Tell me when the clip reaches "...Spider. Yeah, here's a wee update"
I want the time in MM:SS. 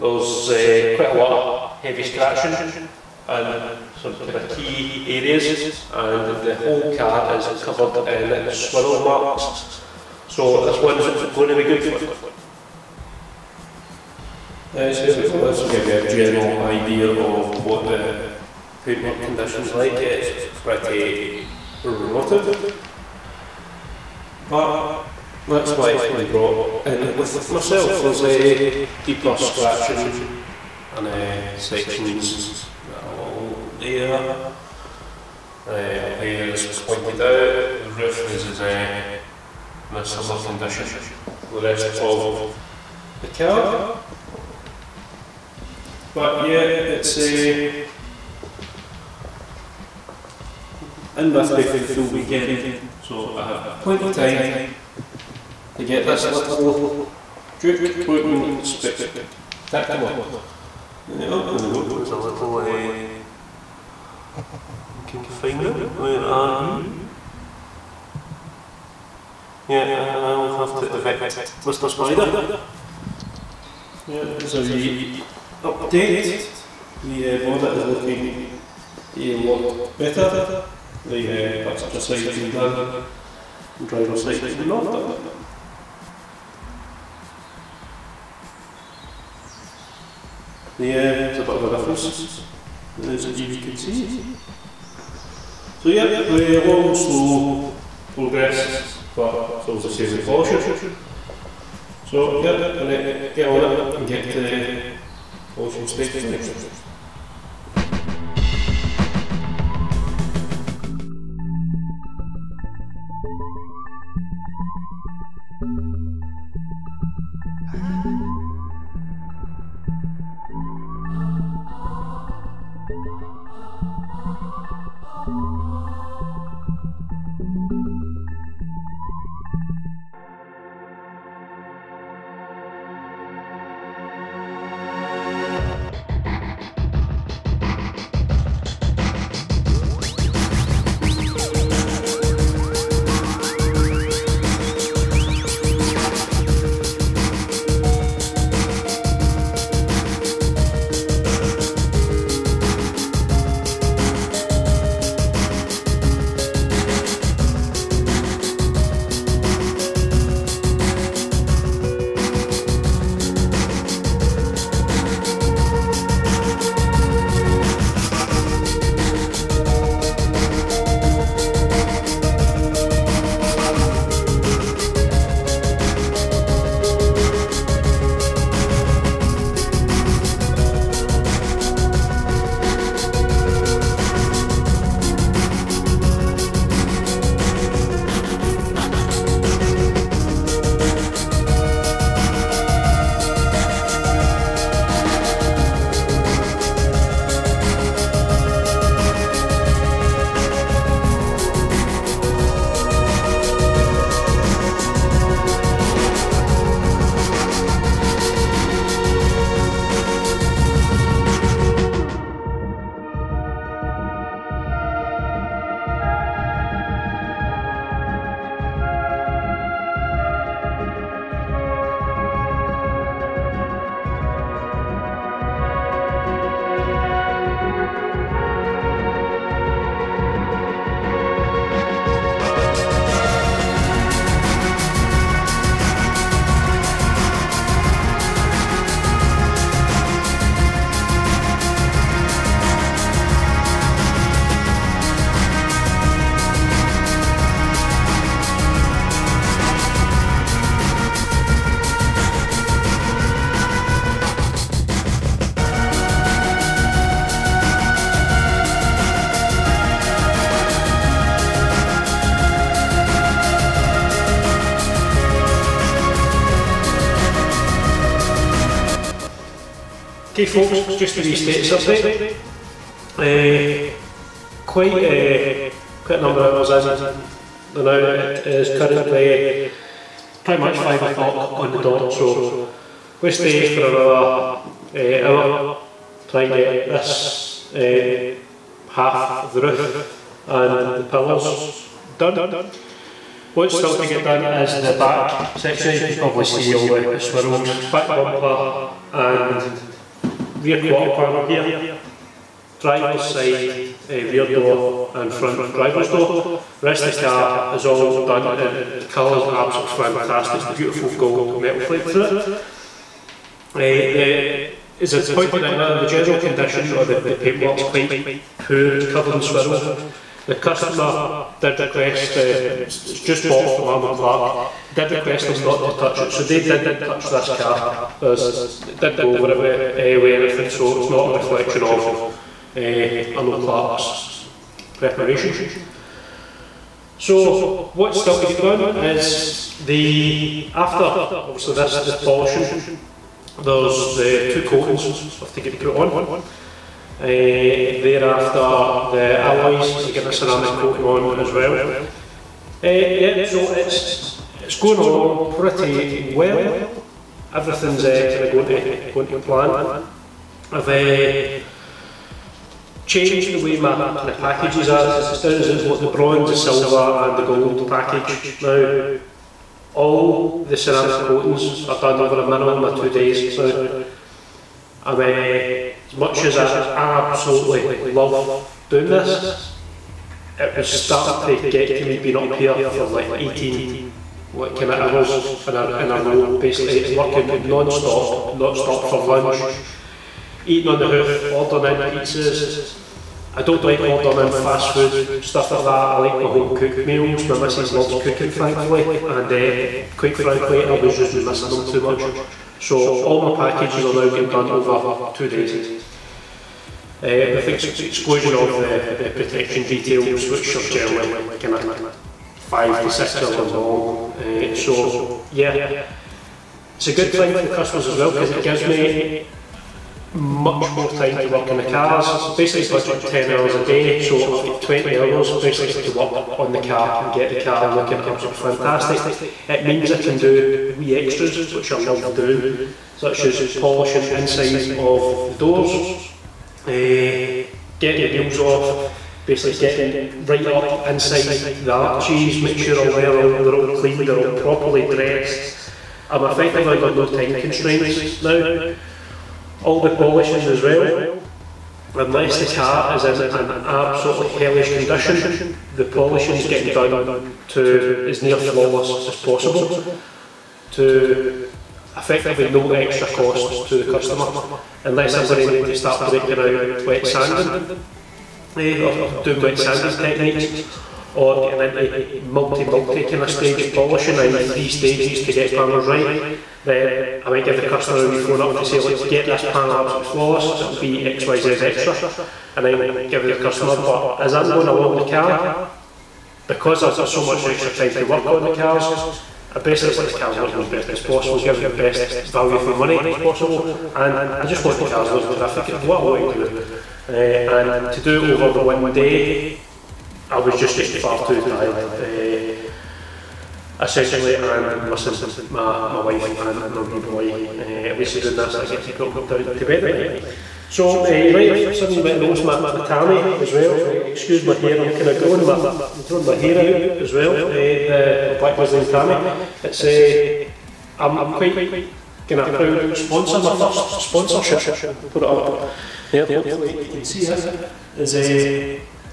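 01:11.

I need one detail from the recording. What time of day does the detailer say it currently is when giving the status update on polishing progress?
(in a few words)
5 o'clock.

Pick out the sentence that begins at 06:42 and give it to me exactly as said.
So all my packages are now getting done over two days.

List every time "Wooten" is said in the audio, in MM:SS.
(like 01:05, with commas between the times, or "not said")
00:58.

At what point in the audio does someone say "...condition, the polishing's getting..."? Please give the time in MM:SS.
07:34.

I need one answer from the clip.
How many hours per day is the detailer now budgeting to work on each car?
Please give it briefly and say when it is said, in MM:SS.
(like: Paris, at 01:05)
10 hours, at 07:03.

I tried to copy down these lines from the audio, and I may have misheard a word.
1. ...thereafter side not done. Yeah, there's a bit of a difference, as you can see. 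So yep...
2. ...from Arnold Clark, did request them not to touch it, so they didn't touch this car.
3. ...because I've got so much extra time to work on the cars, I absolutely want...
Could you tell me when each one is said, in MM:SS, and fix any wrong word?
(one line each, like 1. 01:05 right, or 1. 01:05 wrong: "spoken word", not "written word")
1. 01:23 wrong: "driver", not "thereafter"
2. 05:23 right
3. 08:06 wrong: "basically", not "absolutely".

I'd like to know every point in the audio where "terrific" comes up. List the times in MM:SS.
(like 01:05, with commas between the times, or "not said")
08:15.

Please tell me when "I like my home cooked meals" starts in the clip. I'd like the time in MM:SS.
06:36.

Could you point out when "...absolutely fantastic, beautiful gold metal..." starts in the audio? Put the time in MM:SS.
05:09.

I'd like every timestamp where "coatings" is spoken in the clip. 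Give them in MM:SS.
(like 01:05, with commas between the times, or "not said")
05:44, 05:50, 06:11.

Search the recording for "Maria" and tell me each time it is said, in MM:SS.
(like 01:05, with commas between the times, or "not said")
not said.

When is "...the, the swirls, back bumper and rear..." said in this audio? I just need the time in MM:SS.
04:56.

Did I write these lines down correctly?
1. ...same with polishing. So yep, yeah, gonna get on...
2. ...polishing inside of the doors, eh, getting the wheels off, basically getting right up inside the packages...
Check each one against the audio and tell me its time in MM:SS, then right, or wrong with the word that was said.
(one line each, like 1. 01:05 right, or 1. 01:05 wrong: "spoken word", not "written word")
1. 01:39 right
2. 07:13 wrong: "arches", not "packages".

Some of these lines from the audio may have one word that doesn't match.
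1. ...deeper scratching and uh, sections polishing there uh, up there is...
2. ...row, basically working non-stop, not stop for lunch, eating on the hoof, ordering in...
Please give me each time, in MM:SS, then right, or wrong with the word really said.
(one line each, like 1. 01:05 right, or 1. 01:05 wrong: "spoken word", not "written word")
1. 00:29 wrong: "along", not "polishing"
2. 06:26 right.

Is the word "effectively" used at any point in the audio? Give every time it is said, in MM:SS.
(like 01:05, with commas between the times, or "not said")
07:26, 07:42.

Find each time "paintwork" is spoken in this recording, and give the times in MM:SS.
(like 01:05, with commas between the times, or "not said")
00:18, 05:17.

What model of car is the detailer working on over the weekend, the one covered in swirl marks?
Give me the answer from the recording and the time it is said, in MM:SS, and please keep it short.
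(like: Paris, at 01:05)
Juke, at 00:57.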